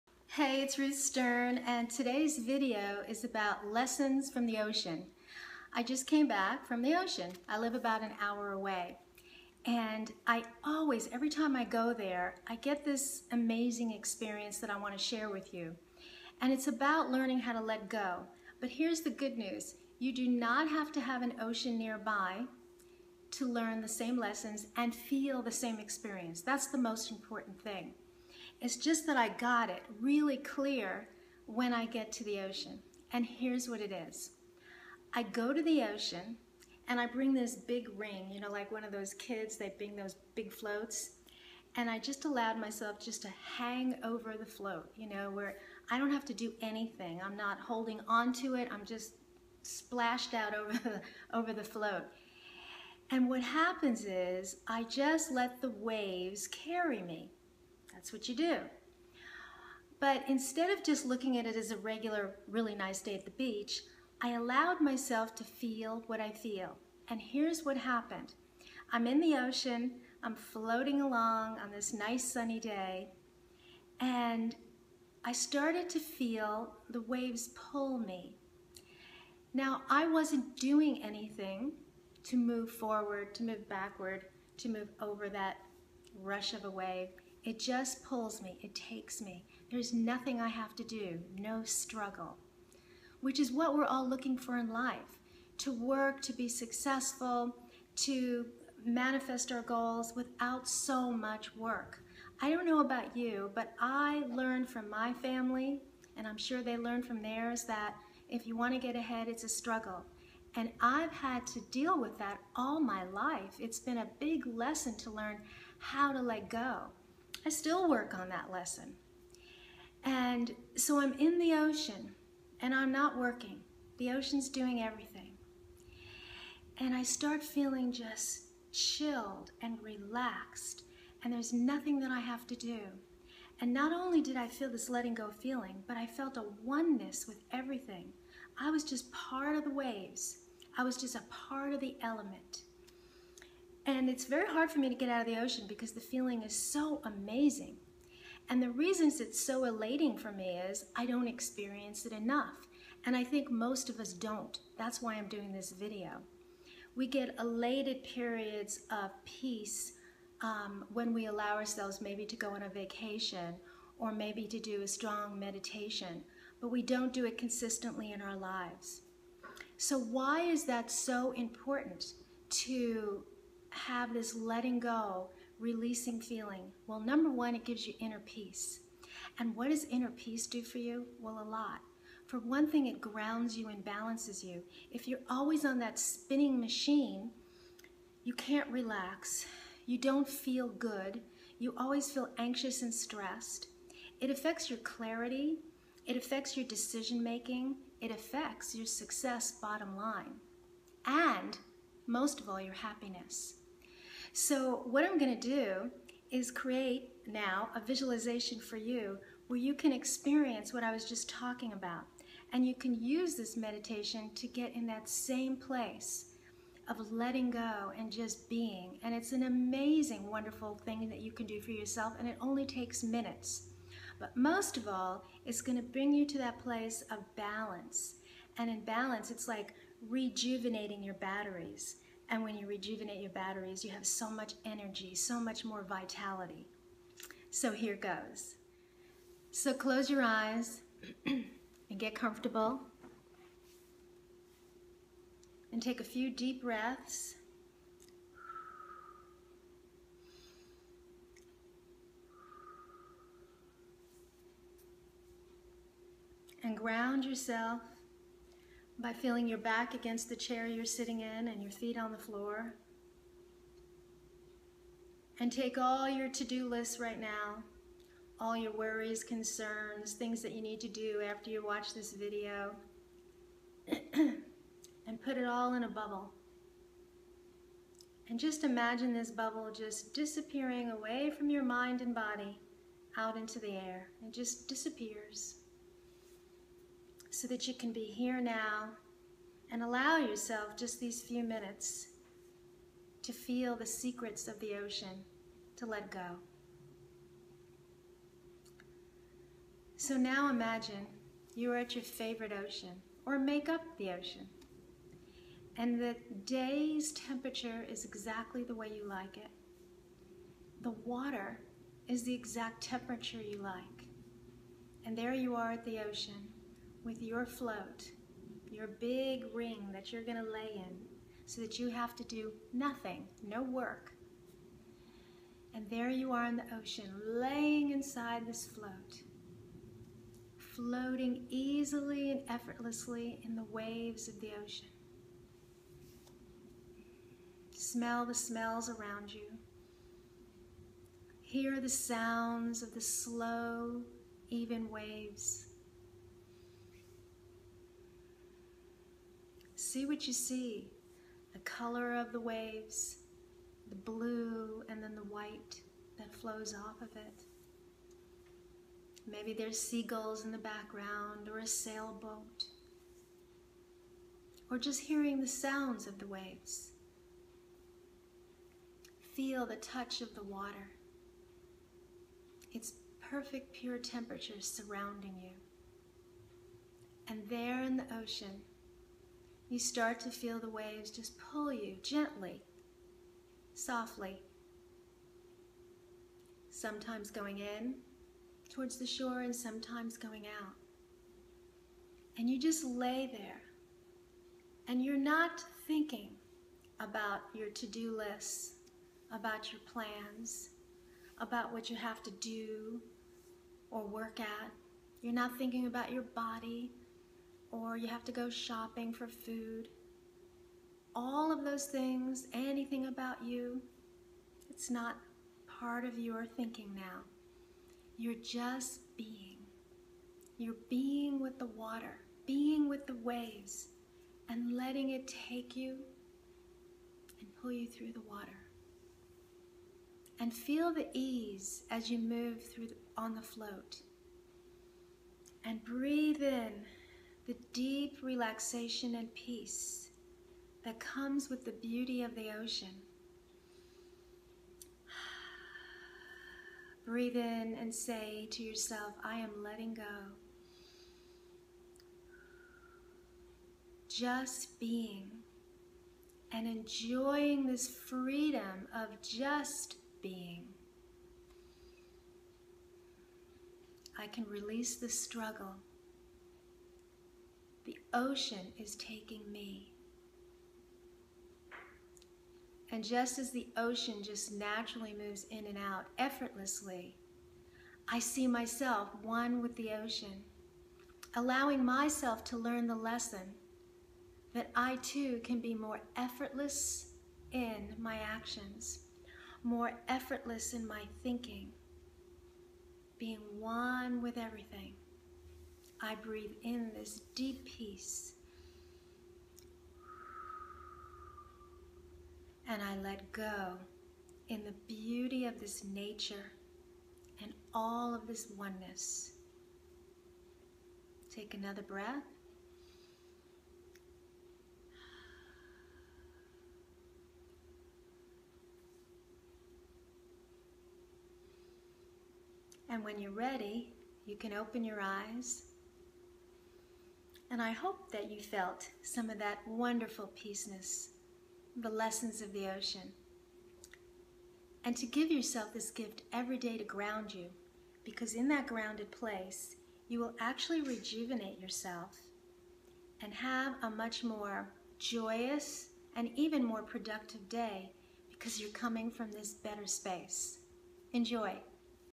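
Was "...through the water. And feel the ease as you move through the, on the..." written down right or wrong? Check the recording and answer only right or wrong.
right.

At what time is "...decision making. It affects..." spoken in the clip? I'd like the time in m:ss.
3:16.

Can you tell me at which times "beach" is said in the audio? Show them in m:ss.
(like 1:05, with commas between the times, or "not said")
1:03.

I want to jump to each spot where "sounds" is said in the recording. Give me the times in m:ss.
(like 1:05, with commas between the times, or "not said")
5:41, 6:05.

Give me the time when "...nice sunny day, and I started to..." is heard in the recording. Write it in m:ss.
1:11.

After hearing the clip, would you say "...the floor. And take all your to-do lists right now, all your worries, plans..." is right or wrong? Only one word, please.
wrong.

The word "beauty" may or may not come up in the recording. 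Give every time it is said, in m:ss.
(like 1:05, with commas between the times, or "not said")
7:21, 8:24.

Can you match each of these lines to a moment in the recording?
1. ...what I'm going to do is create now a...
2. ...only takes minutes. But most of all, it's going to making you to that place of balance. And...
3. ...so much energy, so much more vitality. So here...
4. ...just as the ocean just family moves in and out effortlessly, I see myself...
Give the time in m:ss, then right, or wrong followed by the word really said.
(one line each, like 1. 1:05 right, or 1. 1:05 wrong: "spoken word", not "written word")
1. 3:24 right
2. 3:42 wrong: "bring", not "making"
3. 3:54 right
4. 7:53 wrong: "naturally", not "family".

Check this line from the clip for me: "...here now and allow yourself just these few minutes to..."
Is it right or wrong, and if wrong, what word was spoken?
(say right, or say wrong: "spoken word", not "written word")
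right.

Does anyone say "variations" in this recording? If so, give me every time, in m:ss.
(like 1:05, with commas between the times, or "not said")
not said.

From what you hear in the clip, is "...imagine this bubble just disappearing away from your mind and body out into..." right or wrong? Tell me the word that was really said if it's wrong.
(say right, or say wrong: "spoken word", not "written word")
right.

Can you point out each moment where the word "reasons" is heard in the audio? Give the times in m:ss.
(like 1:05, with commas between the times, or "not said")
2:28.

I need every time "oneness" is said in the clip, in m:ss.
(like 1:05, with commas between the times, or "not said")
2:16, 8:28.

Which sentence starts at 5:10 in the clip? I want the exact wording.
The water is the exact temperature you like.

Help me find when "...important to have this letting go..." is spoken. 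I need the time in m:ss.
2:51.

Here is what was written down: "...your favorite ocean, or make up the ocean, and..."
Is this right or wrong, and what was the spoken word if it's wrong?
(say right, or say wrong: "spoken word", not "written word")
right.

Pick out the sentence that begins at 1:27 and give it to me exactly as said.
It just pulls me, it takes me.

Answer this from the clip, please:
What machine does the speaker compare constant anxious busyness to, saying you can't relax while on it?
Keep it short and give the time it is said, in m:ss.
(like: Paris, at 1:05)
spinning machine, at 3:05.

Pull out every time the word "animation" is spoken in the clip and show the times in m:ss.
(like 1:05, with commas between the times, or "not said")
not said.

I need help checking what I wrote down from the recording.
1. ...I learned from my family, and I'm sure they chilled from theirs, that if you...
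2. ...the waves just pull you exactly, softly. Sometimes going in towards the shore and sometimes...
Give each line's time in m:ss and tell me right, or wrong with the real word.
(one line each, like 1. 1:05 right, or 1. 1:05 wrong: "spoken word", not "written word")
1. 1:43 wrong: "learned", not "chilled"
2. 6:20 wrong: "gently", not "exactly".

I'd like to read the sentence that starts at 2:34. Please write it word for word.
That's why I'm doing this video.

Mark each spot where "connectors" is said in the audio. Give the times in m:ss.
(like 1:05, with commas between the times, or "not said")
not said.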